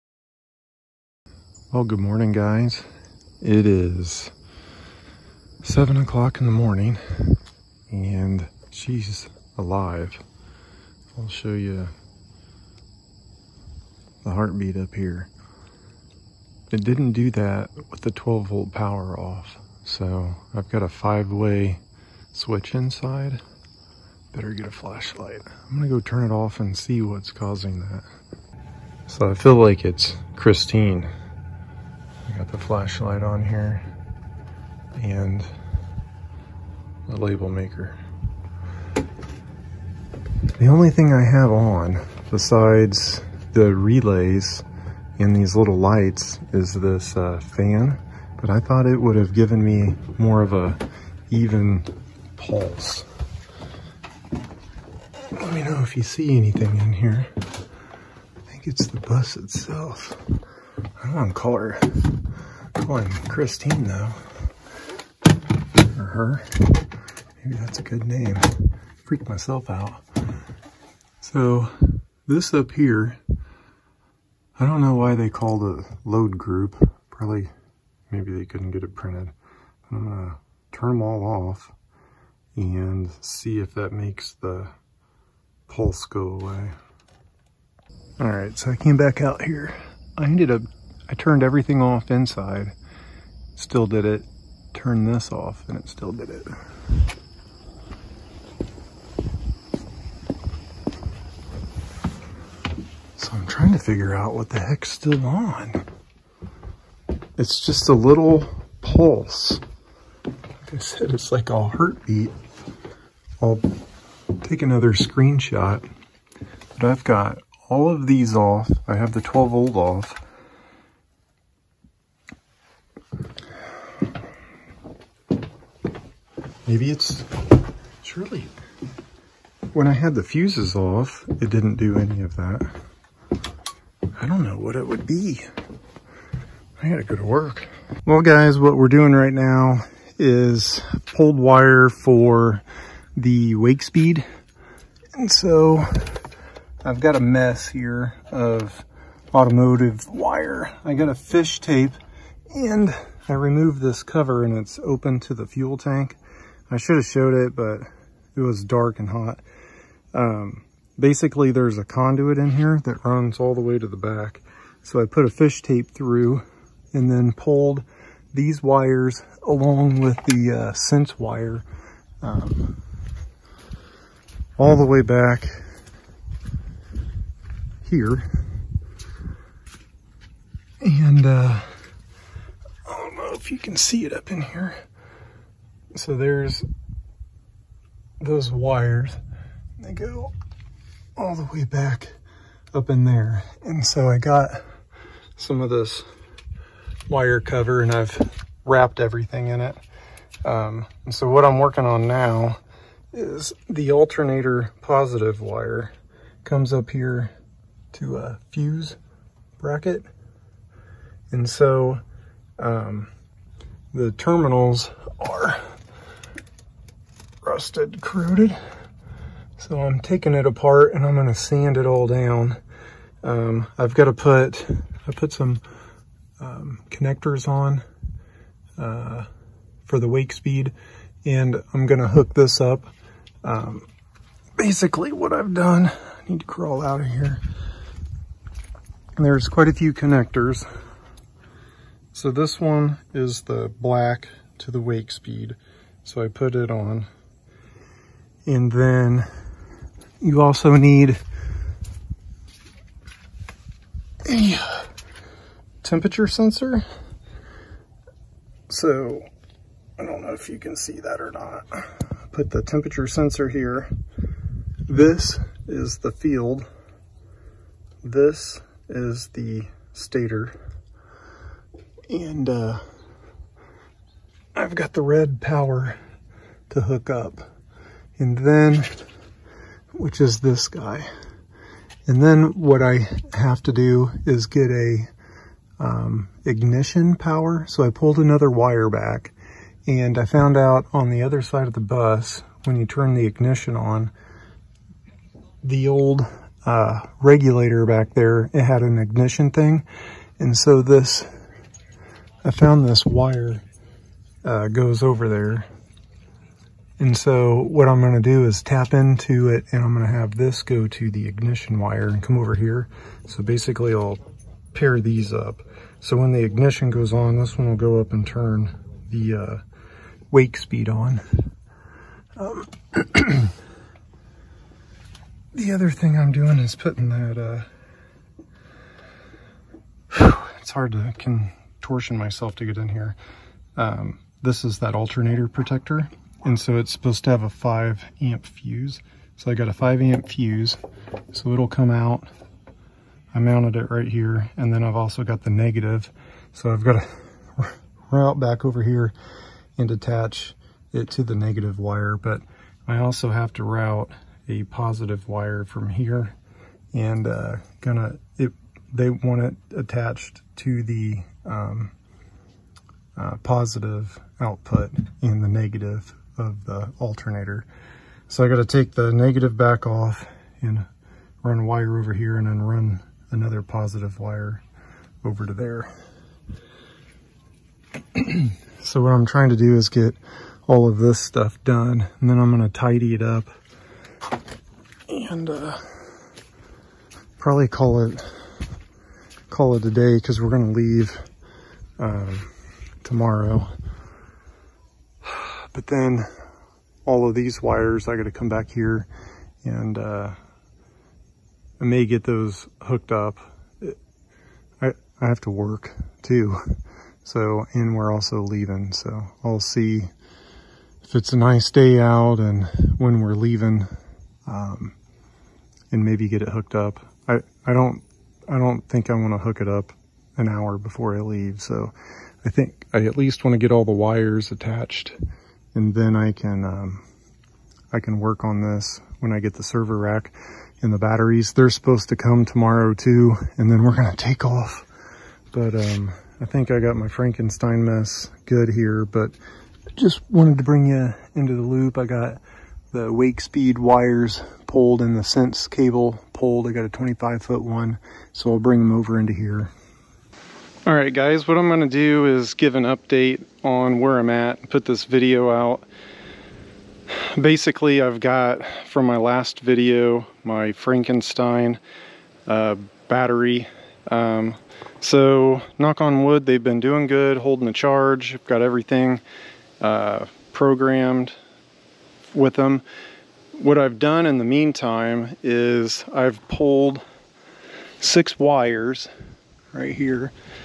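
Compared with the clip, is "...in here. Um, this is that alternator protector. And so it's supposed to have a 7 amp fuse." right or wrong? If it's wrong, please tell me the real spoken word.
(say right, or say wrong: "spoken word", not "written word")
wrong: "5", not "7".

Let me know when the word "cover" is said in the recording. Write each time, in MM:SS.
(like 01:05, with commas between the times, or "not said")
02:34, 03:17.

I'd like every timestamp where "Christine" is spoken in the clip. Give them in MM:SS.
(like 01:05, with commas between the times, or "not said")
00:30, 01:03.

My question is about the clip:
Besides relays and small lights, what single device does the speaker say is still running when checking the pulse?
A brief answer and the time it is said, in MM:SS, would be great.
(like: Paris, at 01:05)
Fan, at 00:47.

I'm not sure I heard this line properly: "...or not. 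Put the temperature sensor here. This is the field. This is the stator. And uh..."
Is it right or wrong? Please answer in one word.
right.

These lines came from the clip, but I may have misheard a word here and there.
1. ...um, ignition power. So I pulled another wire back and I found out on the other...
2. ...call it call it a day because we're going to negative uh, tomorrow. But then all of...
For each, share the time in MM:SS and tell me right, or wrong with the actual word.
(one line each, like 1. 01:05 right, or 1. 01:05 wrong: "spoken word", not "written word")
1. 04:45 right
2. 06:27 wrong: "leave", not "negative".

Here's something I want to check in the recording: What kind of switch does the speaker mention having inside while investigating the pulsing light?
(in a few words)
Five way switch.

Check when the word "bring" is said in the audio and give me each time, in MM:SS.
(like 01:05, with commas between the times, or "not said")
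07:20, 07:28.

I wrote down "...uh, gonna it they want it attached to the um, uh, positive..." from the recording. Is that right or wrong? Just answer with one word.
right.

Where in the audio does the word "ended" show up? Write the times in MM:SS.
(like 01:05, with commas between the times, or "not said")
01:30.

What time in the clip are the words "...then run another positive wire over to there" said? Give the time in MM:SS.
06:12.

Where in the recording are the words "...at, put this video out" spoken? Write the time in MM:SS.
07:34.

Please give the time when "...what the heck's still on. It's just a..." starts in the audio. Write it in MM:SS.
01:44.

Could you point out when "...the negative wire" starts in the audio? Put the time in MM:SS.
05:51.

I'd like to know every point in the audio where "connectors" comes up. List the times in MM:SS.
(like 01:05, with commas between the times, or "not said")
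03:46, 03:59.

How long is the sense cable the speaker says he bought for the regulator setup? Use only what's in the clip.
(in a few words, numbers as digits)
25 feet.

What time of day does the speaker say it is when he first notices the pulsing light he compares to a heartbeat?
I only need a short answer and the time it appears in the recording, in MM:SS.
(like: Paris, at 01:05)
7 o'clock, at 00:05.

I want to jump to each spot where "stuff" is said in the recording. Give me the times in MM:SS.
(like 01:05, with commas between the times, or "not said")
06:21.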